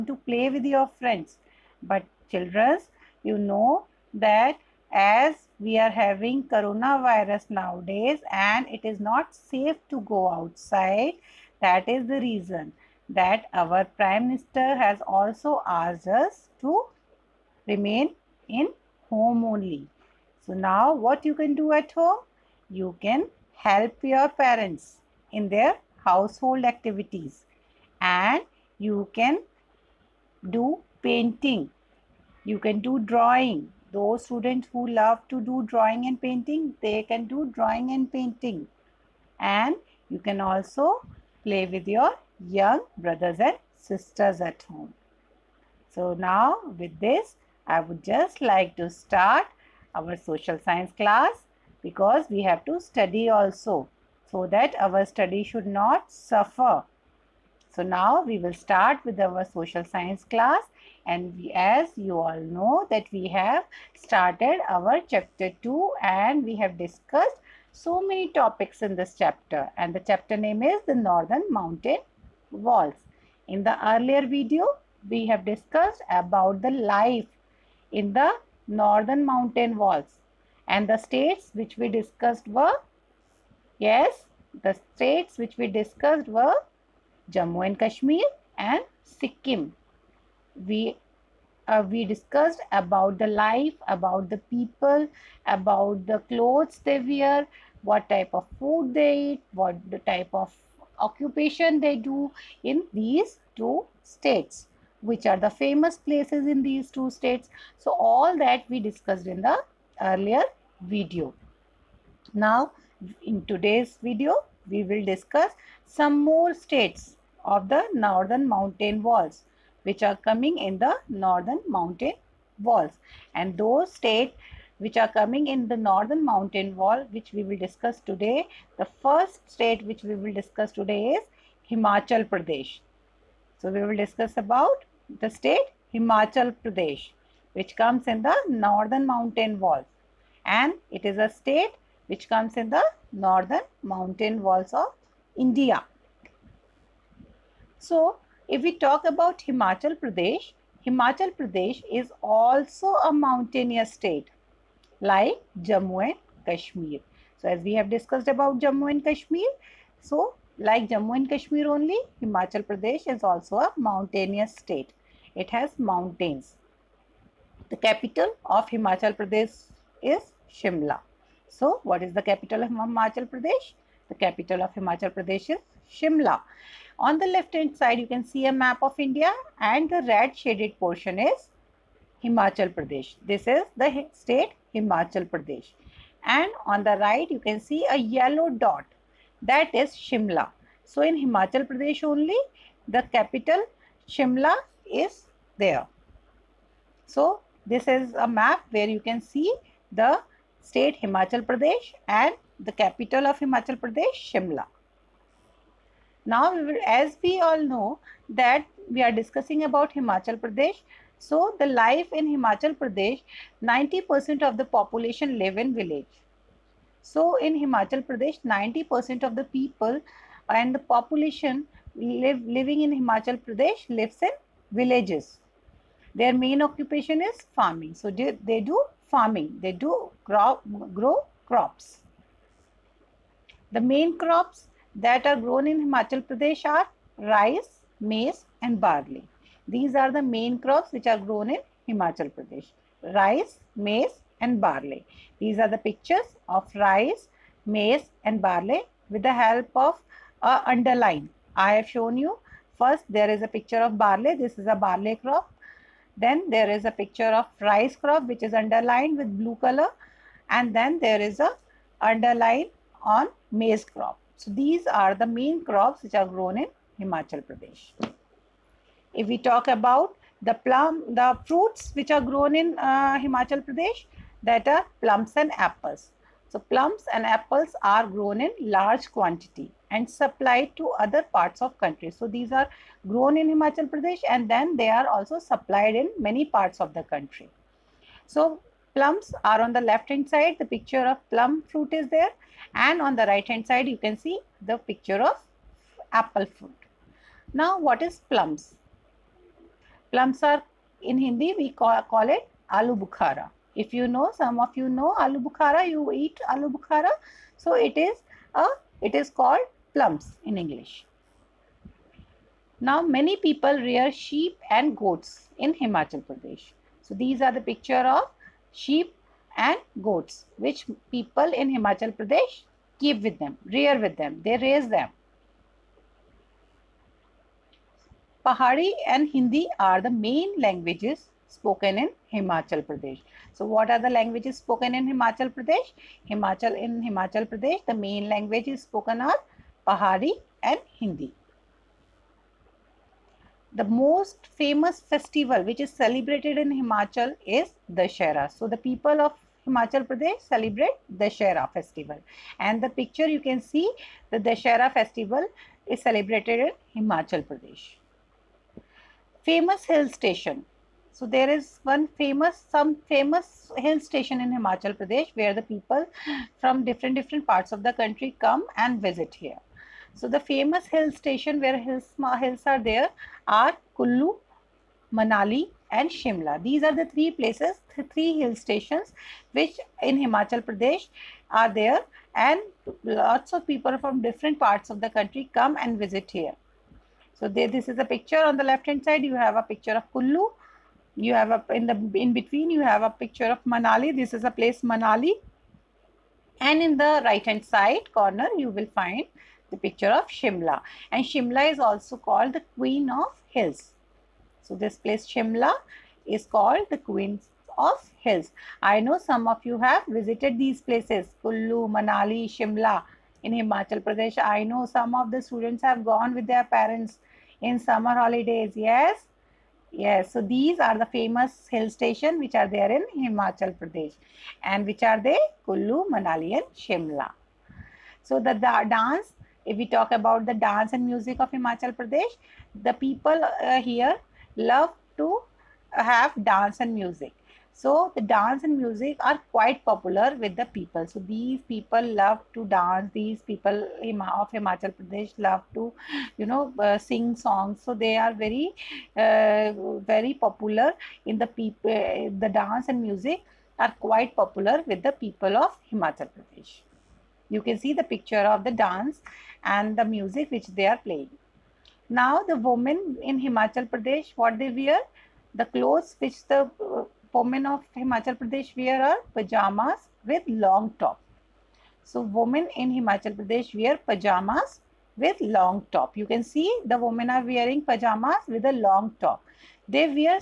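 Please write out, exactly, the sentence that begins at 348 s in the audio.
So the people of Himachal Pradesh celebrate Dashera festival.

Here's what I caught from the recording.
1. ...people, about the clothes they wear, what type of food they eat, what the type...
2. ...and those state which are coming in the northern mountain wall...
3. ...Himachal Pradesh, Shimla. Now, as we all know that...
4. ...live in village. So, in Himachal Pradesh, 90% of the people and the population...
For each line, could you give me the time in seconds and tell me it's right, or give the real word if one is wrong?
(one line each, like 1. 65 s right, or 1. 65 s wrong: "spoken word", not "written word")
1. 94 s right
2. 123 s right
3. 203 s right
4. 215 s right.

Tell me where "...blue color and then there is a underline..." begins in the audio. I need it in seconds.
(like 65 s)
259 s.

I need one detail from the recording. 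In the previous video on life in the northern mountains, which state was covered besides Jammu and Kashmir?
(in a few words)
Sikkim.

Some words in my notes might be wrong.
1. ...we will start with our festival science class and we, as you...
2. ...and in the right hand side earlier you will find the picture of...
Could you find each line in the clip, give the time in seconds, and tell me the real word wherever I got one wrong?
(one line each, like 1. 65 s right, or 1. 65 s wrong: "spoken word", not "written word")
1. 58 s wrong: "social", not "festival"
2. 396 s wrong: "corner", not "earlier".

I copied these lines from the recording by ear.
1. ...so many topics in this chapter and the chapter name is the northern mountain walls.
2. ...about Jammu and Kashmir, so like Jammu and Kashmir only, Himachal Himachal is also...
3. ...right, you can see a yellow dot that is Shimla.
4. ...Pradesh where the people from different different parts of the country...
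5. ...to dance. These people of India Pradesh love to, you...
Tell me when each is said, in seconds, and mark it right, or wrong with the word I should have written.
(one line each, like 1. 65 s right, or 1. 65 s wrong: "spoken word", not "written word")
1. 67 s right
2. 158 s wrong: "Pradesh", not "Himachal"
3. 186 s right
4. 364 s right
5. 442 s wrong: "Himachal", not "India".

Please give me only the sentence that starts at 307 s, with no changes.
So it is a, it is called plums in English.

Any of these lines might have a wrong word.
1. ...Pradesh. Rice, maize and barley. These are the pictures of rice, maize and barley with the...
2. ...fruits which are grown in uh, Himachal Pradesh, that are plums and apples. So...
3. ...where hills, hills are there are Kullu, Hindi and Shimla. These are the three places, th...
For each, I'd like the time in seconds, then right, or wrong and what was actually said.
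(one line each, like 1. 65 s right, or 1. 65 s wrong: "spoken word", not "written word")
1. 242 s right
2. 271 s right
3. 371 s wrong: "Manali", not "Hindi".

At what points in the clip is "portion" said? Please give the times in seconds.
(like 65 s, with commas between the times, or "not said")
180 s.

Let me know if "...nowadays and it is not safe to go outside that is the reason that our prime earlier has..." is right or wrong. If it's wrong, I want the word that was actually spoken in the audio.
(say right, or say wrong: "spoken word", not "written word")
wrong: "minister", not "earlier".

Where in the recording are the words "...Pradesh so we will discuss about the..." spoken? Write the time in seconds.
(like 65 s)
132 s.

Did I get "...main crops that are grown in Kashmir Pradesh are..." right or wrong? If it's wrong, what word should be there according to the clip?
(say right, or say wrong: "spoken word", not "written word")
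wrong: "Himachal", not "Kashmir".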